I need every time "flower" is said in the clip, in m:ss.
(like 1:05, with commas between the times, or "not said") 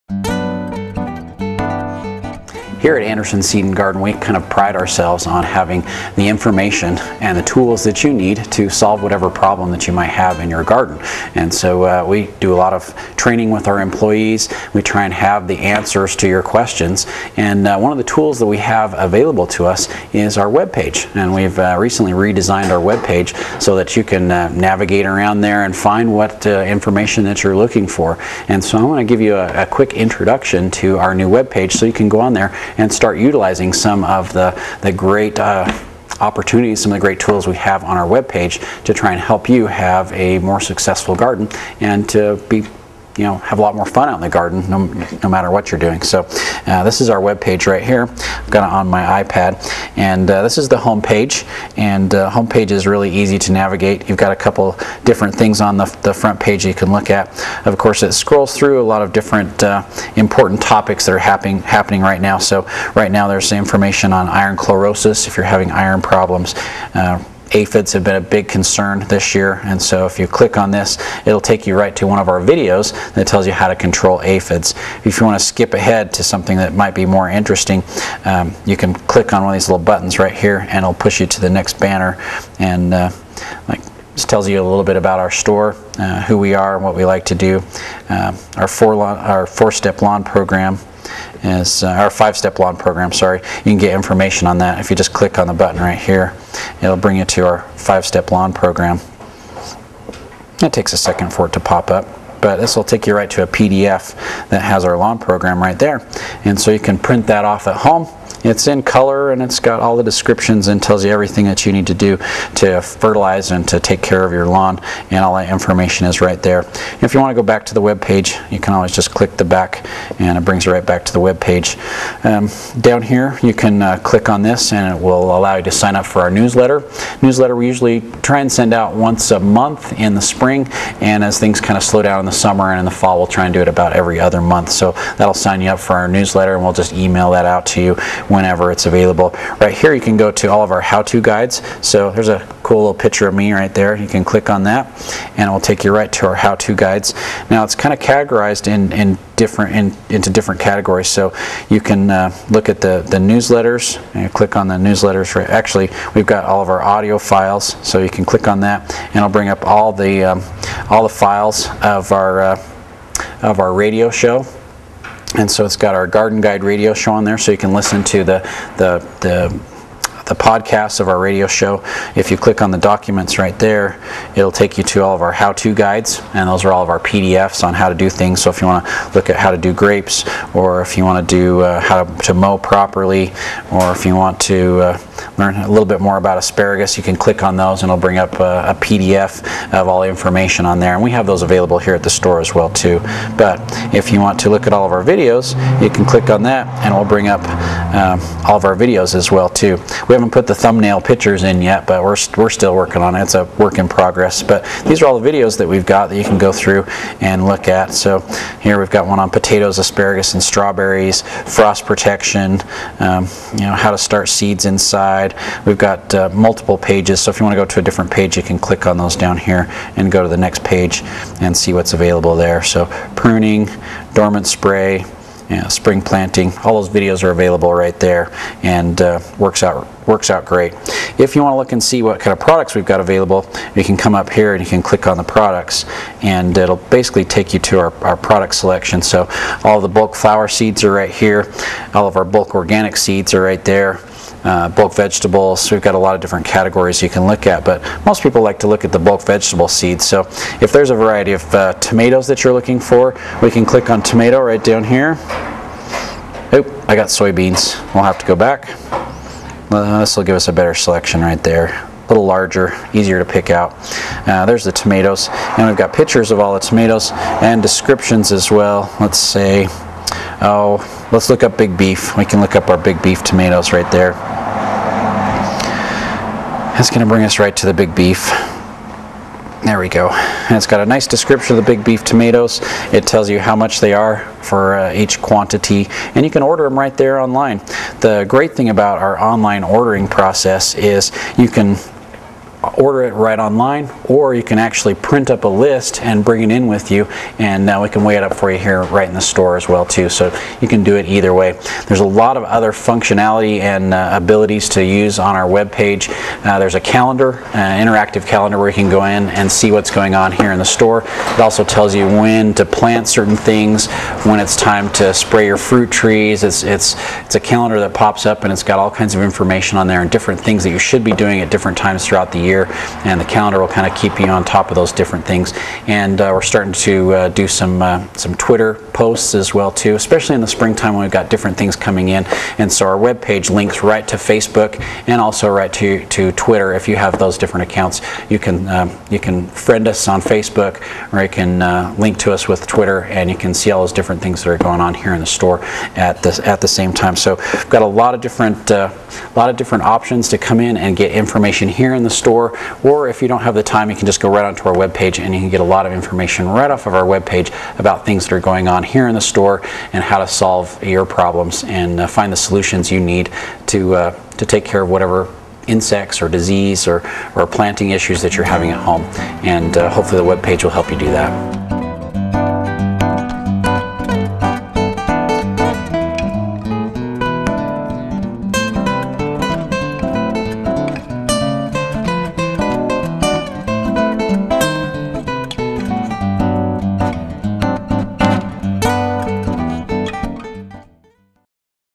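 4:00.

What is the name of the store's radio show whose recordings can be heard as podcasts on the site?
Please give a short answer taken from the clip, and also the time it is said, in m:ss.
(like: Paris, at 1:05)
Garden Guide, at 2:46.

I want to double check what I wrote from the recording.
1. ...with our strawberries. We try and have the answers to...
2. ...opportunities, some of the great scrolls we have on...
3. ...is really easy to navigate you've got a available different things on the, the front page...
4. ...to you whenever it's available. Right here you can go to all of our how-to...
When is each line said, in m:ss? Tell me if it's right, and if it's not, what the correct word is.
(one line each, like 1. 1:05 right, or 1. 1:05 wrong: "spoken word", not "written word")
1. 0:13 wrong: "employees", not "strawberries"
2. 0:36 wrong: "tools", not "scrolls"
3. 0:52 wrong: "couple", not "available"
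4. 2:17 right.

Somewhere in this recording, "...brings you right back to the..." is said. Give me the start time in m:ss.
2:00.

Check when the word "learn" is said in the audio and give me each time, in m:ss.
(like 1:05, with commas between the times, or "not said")
3:05.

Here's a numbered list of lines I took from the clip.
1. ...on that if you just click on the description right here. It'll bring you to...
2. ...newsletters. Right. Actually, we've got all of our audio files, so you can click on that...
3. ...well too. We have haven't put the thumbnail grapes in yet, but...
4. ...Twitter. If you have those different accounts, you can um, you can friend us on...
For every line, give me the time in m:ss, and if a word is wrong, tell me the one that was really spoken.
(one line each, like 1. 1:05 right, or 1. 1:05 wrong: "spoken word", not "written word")
1. 1:34 wrong: "button", not "description"
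2. 2:34 right
3. 3:19 wrong: "pictures", not "grapes"
4. 5:36 right.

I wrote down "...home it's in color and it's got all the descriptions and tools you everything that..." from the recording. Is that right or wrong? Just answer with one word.
wrong.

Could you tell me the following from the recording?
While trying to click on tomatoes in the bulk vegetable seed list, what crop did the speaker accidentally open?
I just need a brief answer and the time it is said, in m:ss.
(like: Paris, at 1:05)
Soybeans, at 4:17.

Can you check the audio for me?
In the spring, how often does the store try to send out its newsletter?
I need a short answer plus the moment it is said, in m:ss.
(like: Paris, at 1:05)
Once a month, at 2:08.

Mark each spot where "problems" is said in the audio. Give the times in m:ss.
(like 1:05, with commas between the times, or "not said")
0:09, 1:06, 6:01.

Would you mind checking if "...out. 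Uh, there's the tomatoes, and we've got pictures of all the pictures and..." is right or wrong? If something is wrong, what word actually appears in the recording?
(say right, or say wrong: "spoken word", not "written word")
wrong: "tomatoes", not "pictures".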